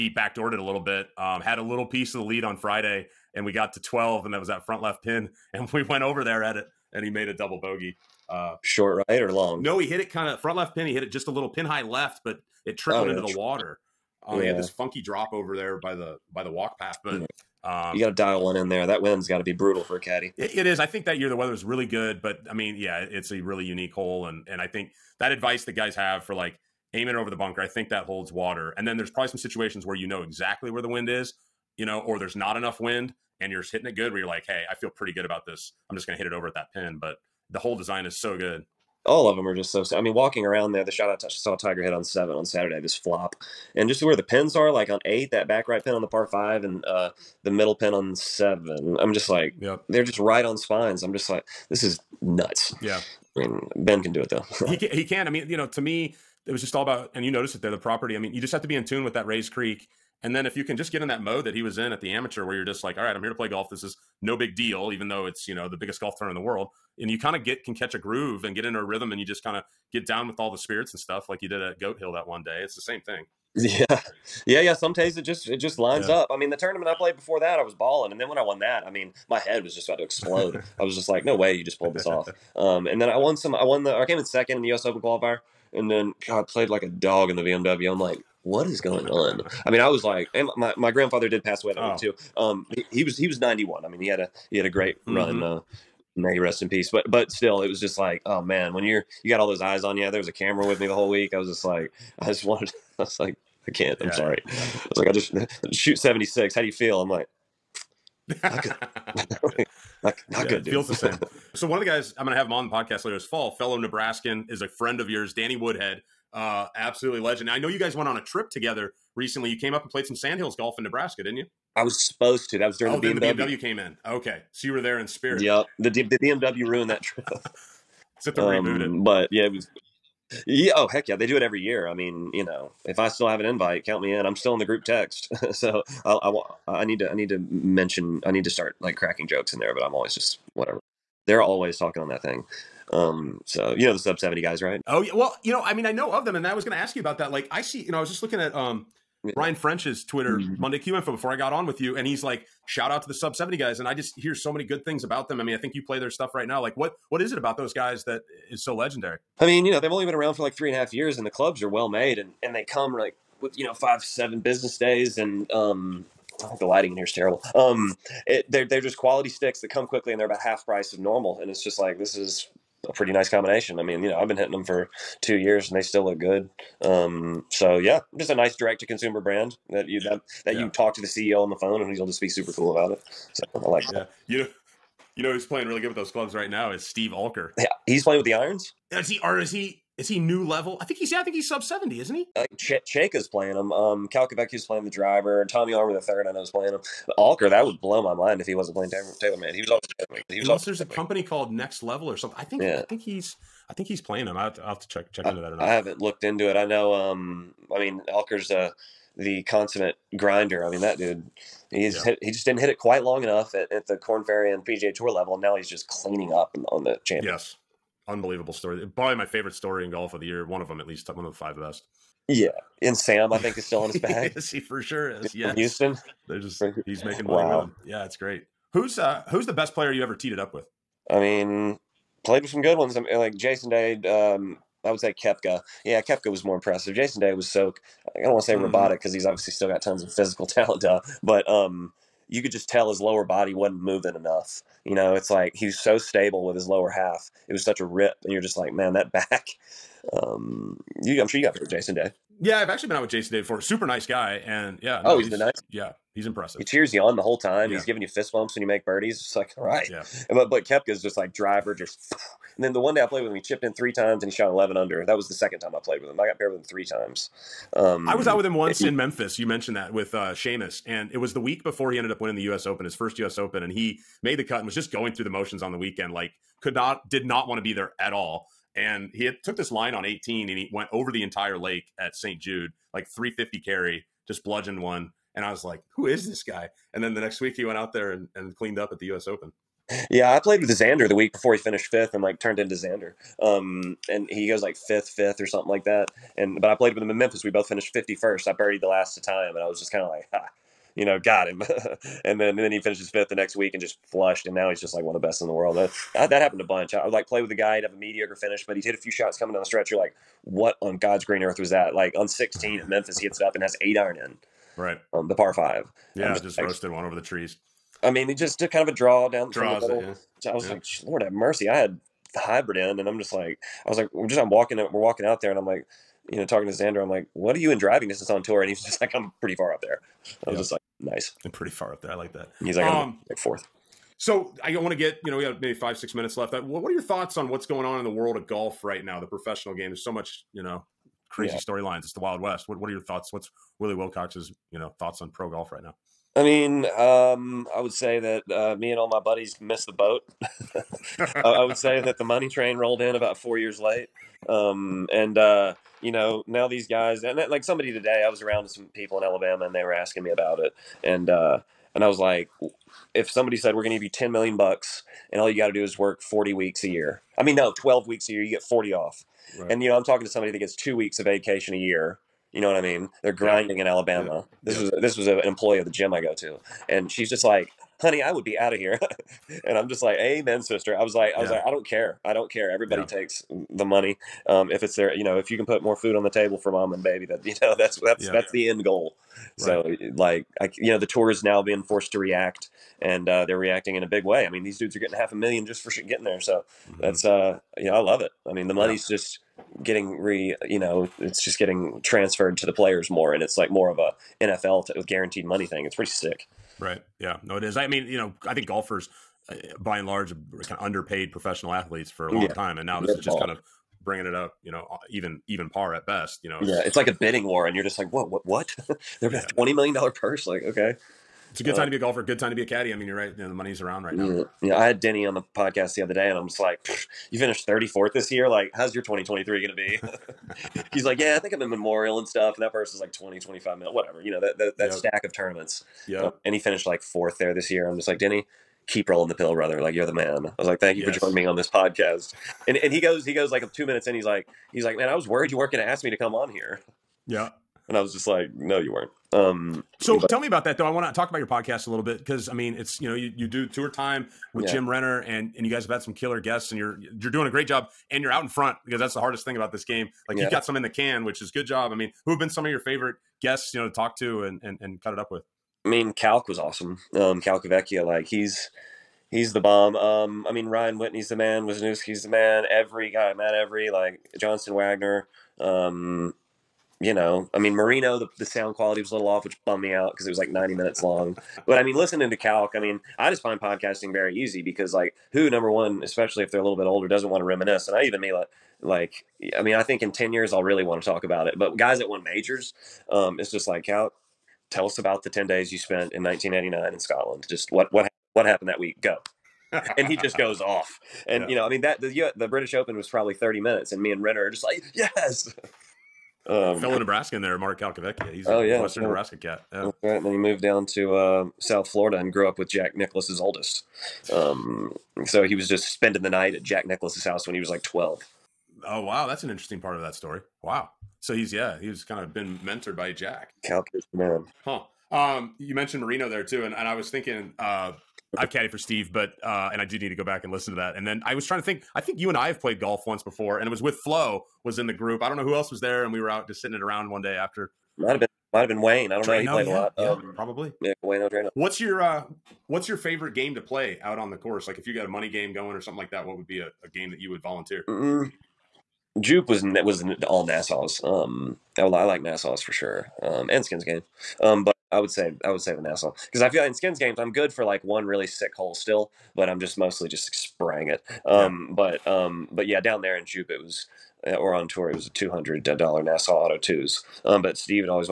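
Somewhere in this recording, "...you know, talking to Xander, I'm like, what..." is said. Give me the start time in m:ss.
5:26.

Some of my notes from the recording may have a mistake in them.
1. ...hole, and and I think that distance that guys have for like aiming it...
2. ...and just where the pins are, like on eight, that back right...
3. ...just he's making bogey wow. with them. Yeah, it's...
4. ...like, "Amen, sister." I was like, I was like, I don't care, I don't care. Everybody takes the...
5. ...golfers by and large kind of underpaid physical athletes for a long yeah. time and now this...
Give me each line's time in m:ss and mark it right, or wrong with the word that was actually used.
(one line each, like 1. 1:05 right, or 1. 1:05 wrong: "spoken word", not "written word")
1. 0:23 wrong: "advice", not "distance"
2. 0:43 right
3. 3:46 wrong: "money", not "bogey"
4. 6:20 right
5. 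6:48 wrong: "professional", not "physical".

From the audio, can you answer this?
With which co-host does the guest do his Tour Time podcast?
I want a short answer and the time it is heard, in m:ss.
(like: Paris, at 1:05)
Jim Renner, at 7:34.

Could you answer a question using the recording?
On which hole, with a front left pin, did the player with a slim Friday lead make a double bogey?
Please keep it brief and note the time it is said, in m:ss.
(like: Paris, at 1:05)
12, at 0:03.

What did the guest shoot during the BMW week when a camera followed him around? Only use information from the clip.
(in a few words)
76.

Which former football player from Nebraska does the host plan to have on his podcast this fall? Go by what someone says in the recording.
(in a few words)
Danny Woodhead.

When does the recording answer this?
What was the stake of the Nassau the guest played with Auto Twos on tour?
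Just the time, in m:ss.
9:25.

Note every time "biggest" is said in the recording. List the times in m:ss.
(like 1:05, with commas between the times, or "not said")
1:05.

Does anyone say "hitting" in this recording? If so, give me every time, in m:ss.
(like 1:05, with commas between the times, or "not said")
0:33, 2:54.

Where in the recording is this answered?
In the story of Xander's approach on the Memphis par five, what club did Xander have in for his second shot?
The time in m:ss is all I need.
5:13.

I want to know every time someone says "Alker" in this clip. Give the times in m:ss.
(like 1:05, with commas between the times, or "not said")
3:07, 3:17, 3:28.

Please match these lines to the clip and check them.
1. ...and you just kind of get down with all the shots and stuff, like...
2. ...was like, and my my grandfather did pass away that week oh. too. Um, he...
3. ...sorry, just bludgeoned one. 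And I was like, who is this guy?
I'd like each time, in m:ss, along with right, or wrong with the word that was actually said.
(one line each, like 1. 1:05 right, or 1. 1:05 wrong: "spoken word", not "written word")
1. 1:09 wrong: "spirits", not "shots"
2. 1:29 right
3. 4:43 wrong: "carry", not "sorry".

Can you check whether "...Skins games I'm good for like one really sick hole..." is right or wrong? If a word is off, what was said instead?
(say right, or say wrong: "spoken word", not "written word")
right.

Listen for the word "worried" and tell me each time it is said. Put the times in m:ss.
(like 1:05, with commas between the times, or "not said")
7:25.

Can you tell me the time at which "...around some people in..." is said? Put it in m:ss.
5:58.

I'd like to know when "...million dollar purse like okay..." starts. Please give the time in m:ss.
6:59.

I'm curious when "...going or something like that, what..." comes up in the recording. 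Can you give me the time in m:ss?
9:05.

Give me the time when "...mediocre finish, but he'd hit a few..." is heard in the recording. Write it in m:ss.
5:07.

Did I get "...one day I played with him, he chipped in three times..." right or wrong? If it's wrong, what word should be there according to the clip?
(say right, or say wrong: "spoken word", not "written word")
right.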